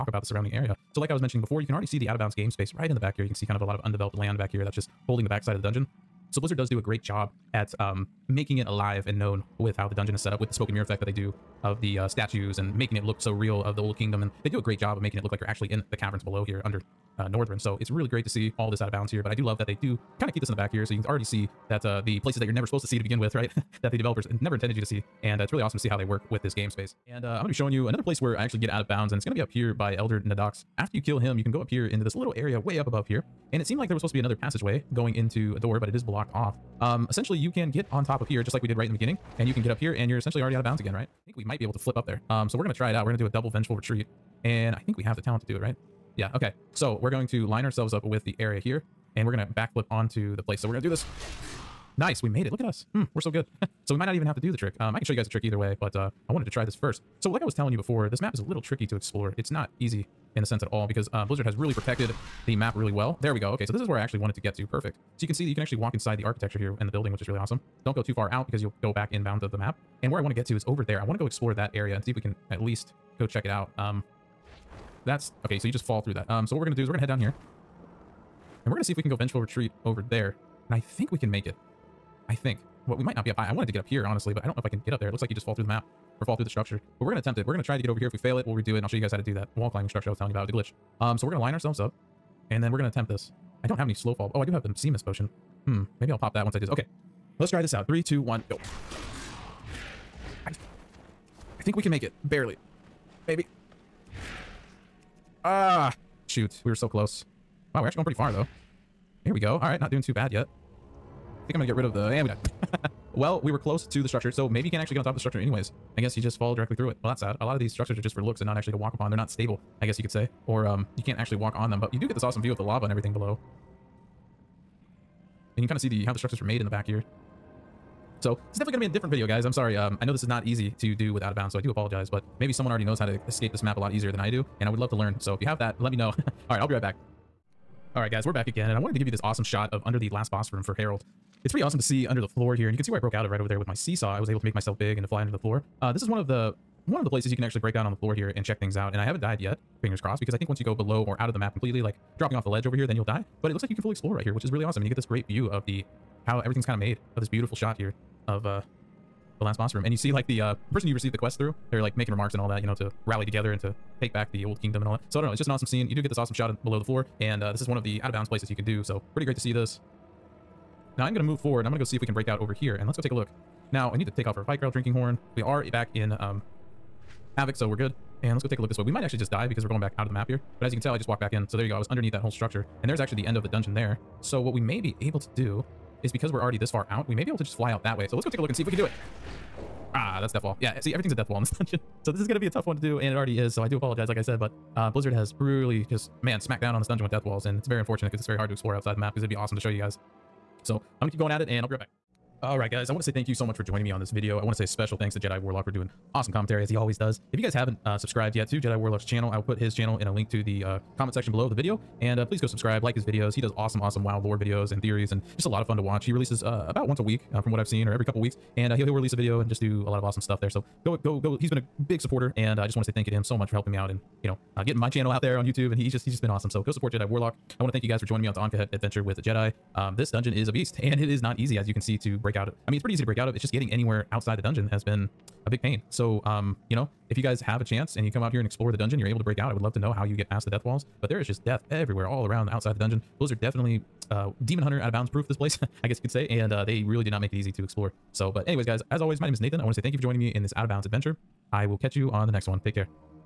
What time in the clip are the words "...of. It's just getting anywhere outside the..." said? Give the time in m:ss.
3:53.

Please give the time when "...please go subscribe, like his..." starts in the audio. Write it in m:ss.
3:32.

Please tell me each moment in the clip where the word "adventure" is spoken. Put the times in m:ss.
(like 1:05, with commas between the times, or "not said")
3:48, 4:10.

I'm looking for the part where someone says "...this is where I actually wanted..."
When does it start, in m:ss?
1:03.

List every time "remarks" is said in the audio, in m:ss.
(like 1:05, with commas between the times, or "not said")
2:42.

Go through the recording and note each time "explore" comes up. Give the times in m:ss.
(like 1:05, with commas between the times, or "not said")
0:58, 1:11, 2:33, 3:18, 3:58, 4:07.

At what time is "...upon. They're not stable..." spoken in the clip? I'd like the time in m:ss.
1:58.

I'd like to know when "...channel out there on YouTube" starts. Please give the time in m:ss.
3:44.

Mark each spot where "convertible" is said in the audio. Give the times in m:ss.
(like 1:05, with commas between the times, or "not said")
not said.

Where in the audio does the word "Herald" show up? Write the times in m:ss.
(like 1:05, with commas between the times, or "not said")
2:20.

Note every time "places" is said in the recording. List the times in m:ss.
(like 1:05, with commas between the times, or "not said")
0:22, 0:28, 0:50, 2:27, 2:48, 4:05.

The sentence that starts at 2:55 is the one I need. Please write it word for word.
We are back in um, Havoc, so we're good.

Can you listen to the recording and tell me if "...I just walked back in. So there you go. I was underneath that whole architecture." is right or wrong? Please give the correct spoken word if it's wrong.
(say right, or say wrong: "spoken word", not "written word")
wrong: "structure", not "architecture".